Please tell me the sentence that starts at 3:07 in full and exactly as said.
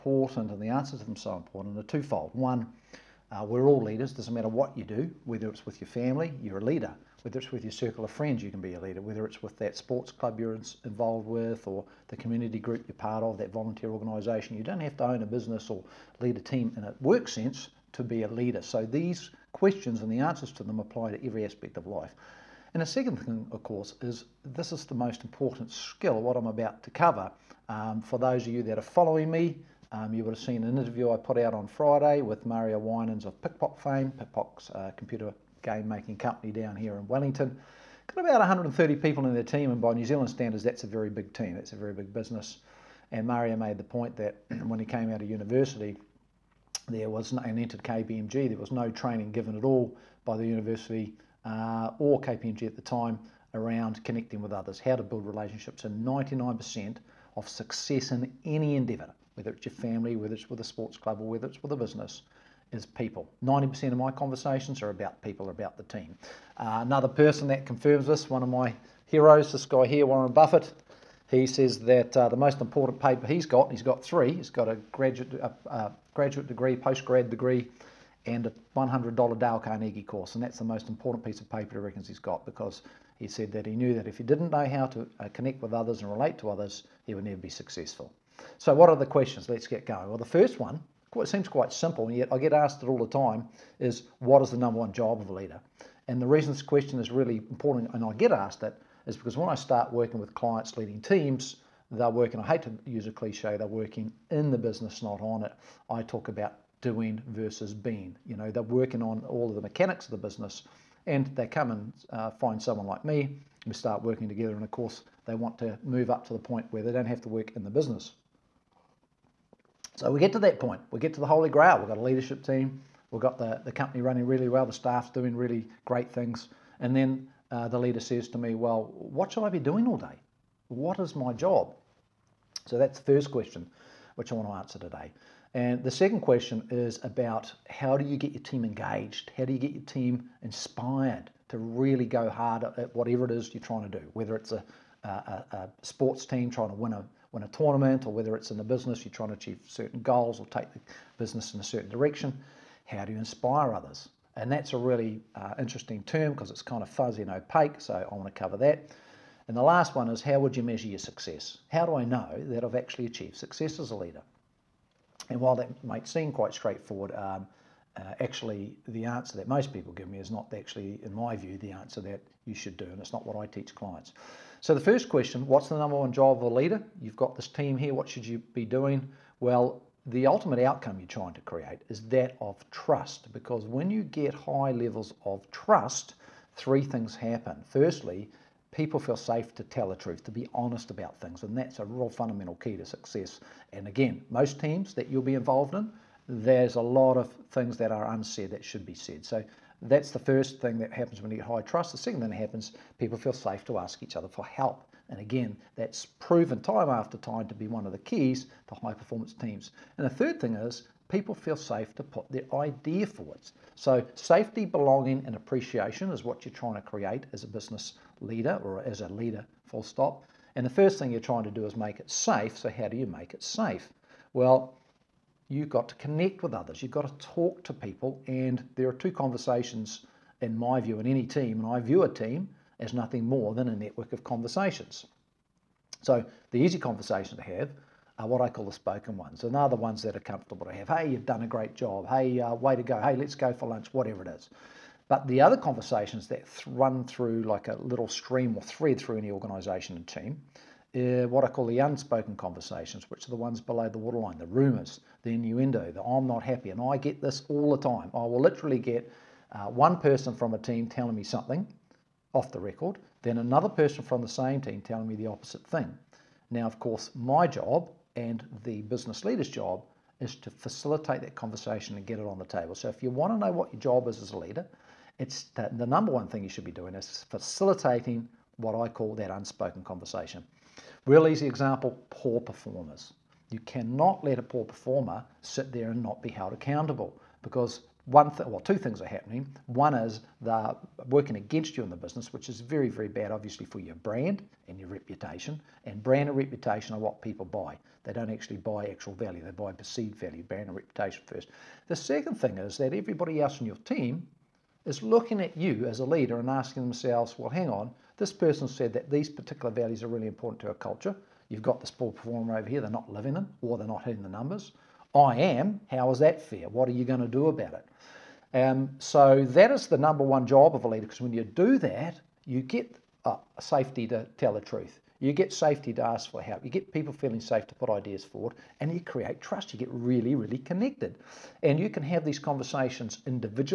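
Firstly, people feel safe to tell the truth, to be honest about things, and that's a real fundamental key to success.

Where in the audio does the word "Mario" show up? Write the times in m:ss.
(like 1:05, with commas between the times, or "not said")
0:32, 0:43.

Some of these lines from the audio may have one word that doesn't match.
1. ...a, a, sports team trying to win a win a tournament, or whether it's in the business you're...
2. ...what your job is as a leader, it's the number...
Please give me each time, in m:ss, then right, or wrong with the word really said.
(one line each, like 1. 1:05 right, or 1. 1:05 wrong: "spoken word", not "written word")
1. 2:25 right
2. 4:33 right.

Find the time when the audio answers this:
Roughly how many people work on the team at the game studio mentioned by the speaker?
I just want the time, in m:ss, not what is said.
0:38.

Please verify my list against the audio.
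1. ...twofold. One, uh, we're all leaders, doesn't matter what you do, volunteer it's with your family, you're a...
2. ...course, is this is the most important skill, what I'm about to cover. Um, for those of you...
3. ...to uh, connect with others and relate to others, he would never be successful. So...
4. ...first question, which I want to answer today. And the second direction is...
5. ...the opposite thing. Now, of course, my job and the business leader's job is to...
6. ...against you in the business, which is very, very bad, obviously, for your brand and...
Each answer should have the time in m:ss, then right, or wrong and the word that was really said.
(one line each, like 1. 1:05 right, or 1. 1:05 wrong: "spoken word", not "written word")
1. 0:01 wrong: "whether", not "volunteer"
2. 0:23 right
3. 1:24 right
4. 2:13 wrong: "question", not "direction"
5. 4:25 right
6. 4:51 right.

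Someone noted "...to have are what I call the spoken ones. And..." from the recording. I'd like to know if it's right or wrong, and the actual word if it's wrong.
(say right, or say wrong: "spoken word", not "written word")
right.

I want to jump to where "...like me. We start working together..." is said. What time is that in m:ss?
1:52.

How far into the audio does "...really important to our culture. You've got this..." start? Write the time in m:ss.
5:10.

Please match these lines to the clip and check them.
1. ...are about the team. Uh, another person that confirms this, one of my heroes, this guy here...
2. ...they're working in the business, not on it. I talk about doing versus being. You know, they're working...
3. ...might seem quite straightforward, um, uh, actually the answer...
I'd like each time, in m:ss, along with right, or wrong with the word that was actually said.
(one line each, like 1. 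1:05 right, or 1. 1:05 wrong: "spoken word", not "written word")
1. 1:05 right
2. 1:43 right
3. 2:45 right.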